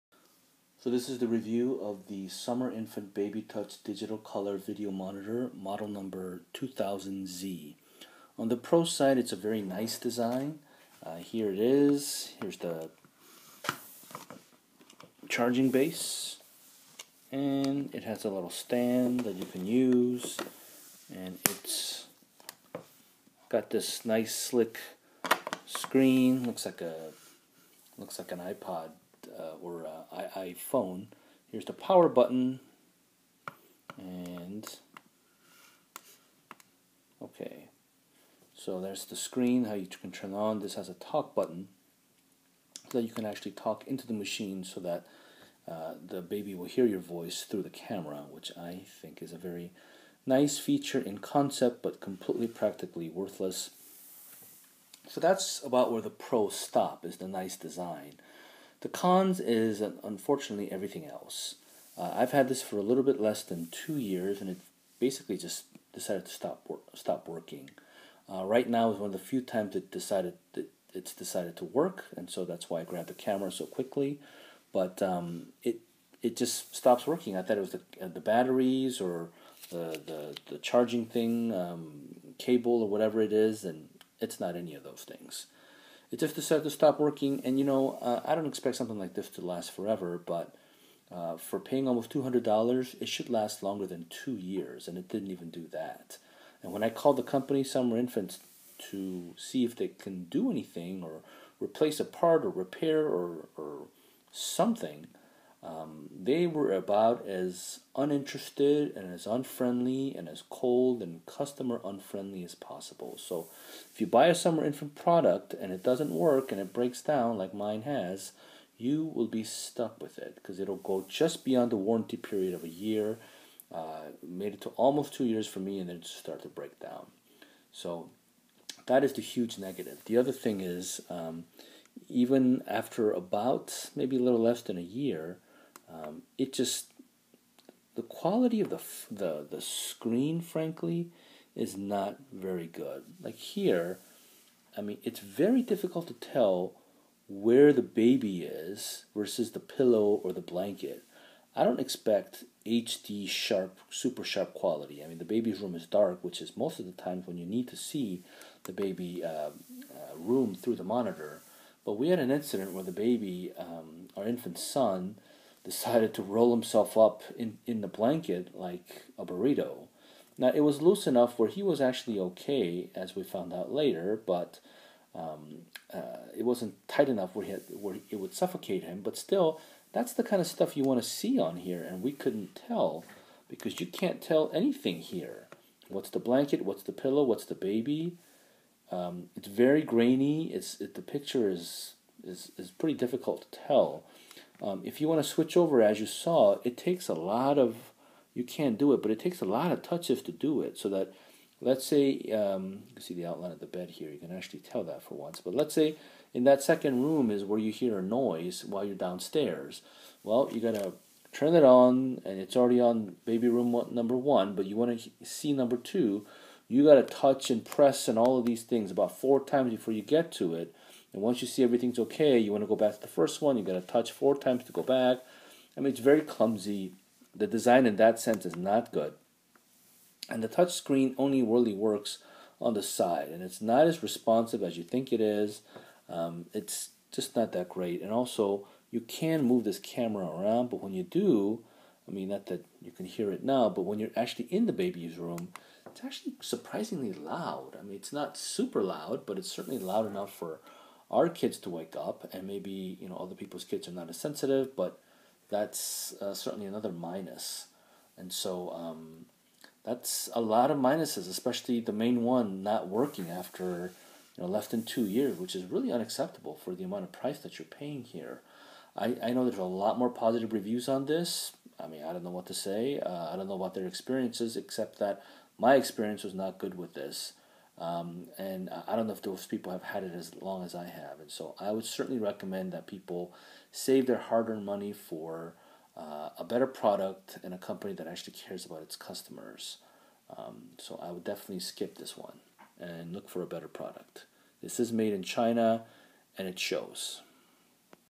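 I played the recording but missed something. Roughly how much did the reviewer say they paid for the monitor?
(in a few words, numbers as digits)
$200.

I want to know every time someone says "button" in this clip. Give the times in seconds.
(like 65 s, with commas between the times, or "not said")
32 s, 41 s.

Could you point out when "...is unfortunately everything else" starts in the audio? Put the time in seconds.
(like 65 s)
59 s.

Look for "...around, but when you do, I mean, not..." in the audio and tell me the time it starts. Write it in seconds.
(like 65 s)
240 s.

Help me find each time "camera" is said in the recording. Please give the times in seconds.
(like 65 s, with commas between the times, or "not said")
47 s, 73 s, 239 s.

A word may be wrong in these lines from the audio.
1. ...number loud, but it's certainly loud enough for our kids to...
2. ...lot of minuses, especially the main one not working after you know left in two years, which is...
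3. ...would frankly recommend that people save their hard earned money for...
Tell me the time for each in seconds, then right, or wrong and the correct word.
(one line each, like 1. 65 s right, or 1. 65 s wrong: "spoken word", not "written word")
1. 248 s wrong: "super", not "number"
2. 260 s right
3. 281 s wrong: "certainly", not "frankly".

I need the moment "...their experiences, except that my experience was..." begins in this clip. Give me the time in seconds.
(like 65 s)
273 s.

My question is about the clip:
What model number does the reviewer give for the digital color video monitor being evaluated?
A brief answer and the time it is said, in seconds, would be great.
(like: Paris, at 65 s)
2000Z, at 6 s.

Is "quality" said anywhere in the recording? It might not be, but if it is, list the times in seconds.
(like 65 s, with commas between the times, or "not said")
138 s, 154 s.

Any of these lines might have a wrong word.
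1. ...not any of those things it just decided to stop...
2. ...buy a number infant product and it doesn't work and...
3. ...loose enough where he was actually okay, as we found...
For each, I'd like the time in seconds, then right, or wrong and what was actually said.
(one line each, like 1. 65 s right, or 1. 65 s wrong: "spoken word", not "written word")
1. 84 s right
2. 114 s wrong: "summer", not "number"
3. 170 s right.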